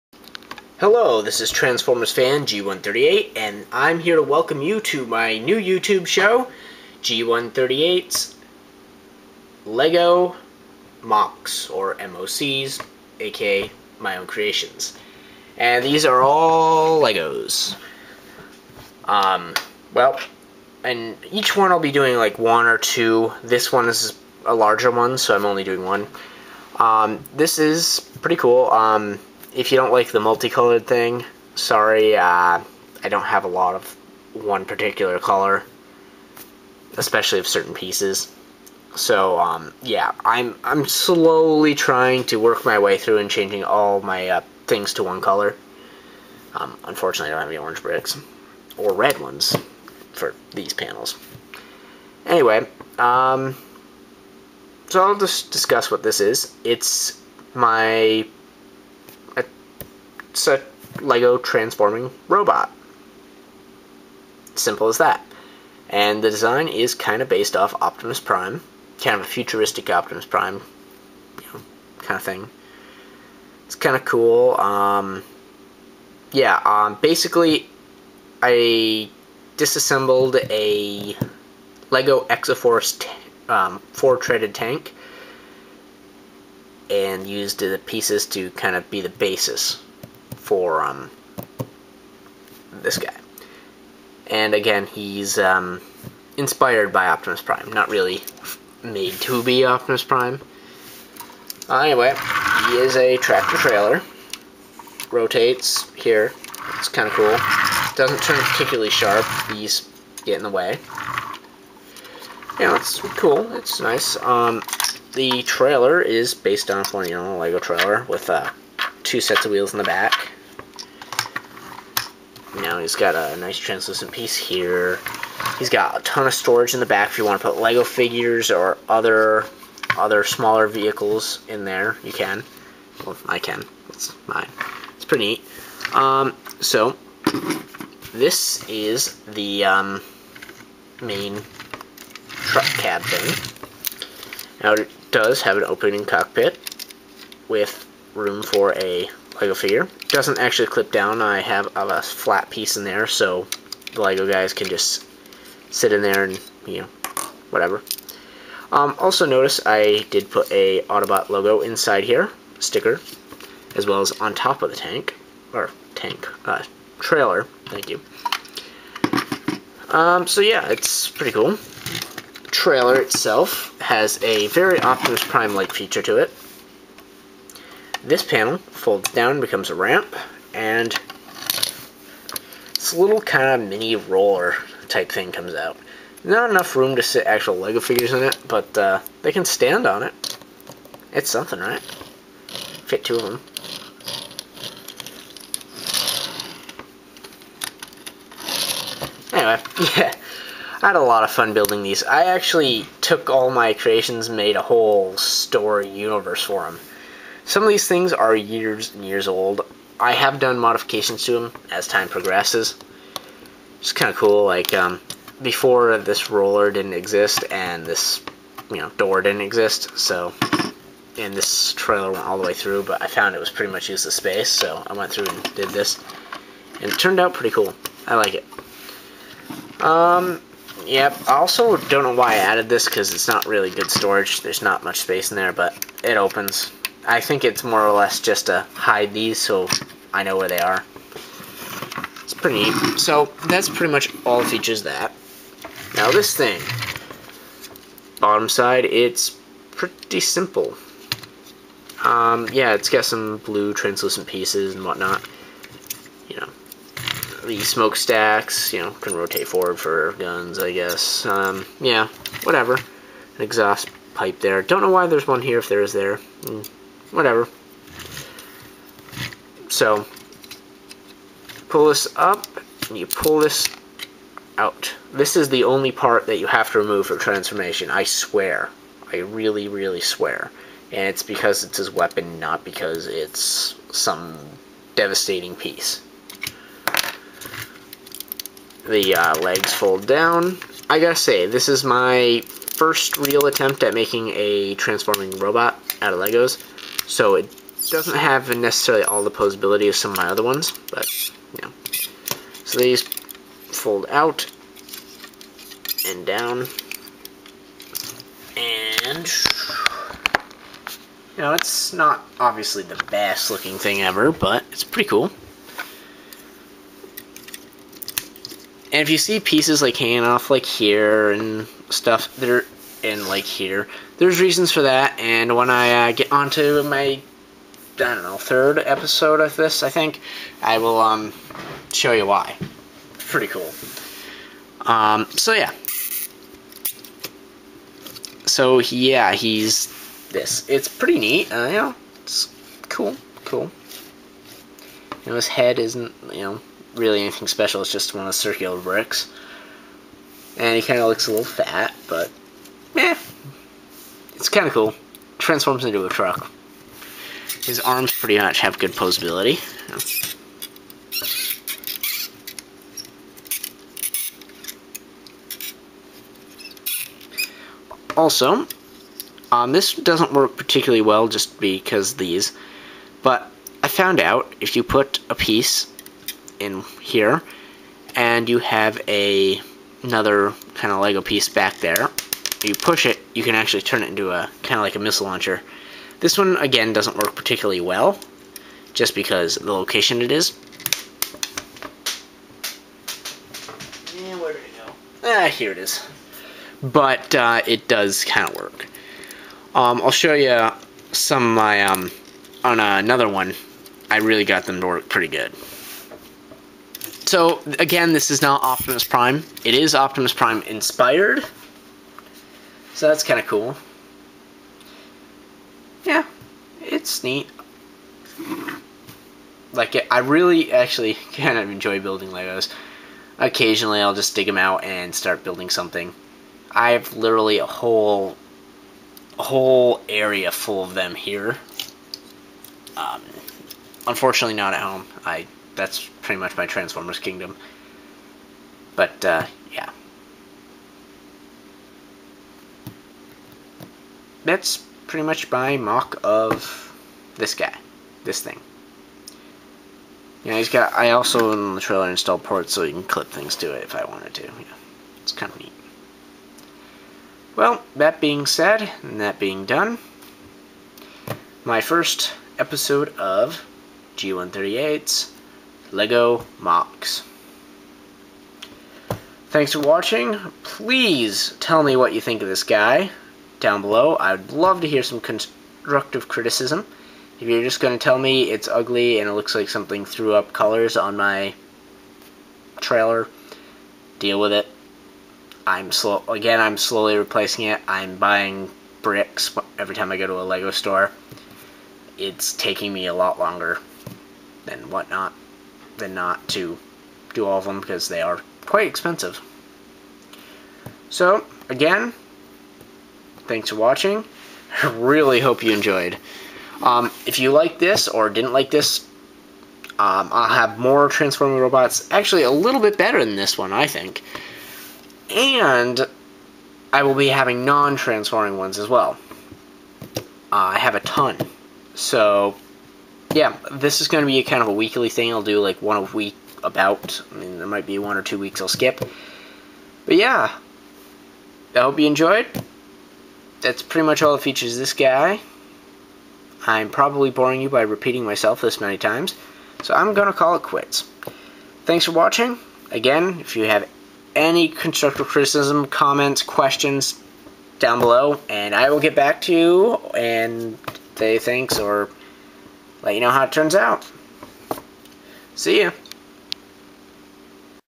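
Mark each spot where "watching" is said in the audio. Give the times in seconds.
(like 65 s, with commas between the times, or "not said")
469 s, 503 s, 542 s.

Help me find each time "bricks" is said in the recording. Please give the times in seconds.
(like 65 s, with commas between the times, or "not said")
47 s, 348 s, 489 s.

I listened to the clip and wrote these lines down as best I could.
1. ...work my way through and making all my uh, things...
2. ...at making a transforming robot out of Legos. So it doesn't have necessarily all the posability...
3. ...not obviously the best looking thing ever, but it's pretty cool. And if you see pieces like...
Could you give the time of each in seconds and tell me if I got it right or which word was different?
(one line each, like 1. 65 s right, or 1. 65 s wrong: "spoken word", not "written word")
1. 42 s wrong: "changing", not "making"
2. 293 s right
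3. 311 s right.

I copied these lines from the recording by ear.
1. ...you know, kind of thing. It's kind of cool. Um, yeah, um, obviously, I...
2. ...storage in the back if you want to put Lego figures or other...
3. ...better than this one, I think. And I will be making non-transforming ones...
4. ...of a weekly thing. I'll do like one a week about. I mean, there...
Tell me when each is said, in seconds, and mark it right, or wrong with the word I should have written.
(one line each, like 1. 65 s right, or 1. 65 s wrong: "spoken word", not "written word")
1. 71 s wrong: "basically", not "obviously"
2. 126 s right
3. 512 s wrong: "having", not "making"
4. 524 s right.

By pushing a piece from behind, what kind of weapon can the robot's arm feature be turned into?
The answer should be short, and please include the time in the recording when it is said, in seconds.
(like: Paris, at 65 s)
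Missile launcher, at 384 s.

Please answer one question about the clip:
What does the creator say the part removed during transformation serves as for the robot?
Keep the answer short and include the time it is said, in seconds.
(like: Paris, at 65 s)
His weapon, at 281 s.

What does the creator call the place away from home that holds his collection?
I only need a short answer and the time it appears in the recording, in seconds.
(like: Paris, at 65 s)
Transformers Kingdom, at 436 s.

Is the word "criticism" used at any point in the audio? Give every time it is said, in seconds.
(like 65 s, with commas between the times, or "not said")
476 s, 545 s.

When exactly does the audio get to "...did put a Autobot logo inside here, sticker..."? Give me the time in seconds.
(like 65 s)
160 s.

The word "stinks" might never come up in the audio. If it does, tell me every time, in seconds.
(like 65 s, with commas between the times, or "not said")
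not said.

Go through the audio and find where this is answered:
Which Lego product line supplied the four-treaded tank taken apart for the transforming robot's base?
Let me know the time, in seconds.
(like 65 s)
82 s.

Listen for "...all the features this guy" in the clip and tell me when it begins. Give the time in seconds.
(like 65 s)
534 s.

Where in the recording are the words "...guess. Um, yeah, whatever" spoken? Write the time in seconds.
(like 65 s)
260 s.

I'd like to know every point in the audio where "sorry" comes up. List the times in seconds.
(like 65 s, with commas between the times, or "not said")
31 s.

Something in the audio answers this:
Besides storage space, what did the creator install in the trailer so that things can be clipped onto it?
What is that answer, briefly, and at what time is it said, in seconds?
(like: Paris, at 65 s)
Ports, at 452 s.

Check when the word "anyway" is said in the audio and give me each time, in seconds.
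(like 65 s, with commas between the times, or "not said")
52 s, 101 s, 199 s.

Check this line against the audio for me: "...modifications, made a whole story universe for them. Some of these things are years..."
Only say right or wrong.
wrong.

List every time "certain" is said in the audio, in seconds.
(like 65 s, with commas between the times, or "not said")
37 s.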